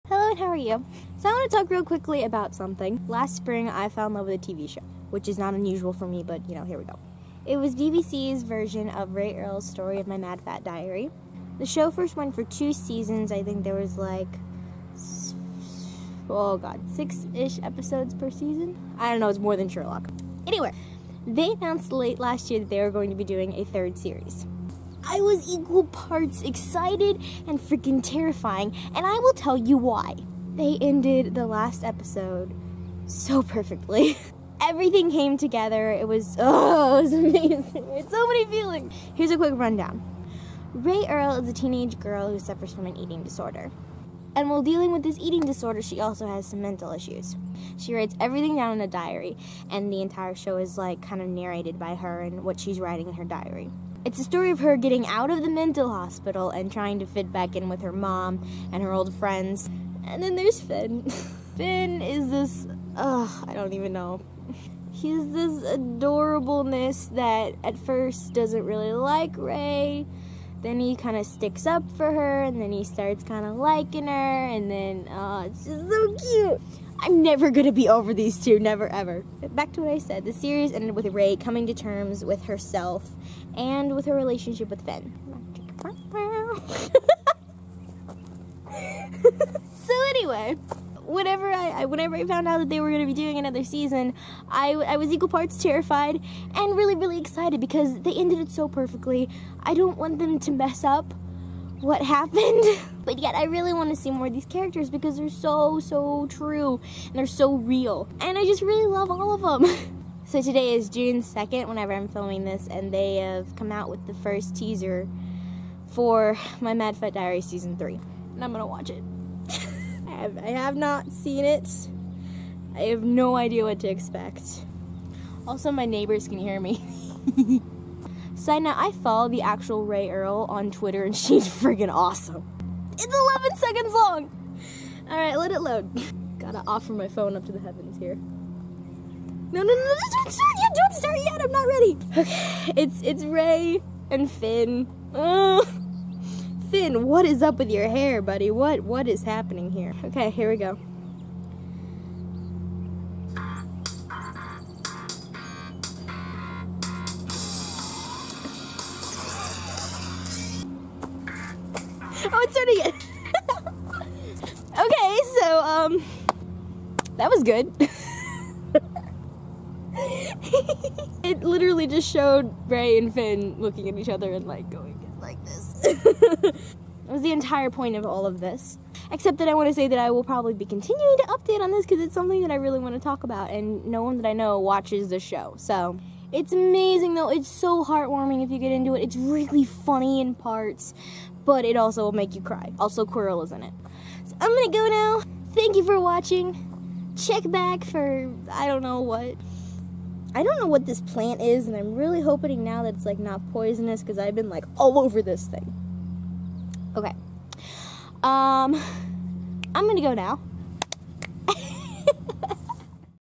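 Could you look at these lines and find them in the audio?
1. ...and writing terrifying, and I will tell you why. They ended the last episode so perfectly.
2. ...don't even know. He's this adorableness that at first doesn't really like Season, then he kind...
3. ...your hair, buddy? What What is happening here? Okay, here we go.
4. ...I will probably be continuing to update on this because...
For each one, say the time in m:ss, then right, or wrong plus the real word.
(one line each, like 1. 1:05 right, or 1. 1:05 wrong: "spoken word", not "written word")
1. 0:27 wrong: "freaking", not "writing"
2. 1:03 wrong: "Rae", not "Season"
3. 2:27 right
4. 2:59 right.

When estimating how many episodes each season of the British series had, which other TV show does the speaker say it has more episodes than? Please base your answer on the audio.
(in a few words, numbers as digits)
Sherlock.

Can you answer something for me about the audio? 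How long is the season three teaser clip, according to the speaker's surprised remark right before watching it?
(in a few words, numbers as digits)
11 seconds.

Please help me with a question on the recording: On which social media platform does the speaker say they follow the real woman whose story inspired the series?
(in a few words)
Twitter.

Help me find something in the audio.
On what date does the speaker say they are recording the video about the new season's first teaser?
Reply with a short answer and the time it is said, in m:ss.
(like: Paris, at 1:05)
June 2, at 1:50.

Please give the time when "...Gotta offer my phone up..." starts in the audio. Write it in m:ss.
2:16.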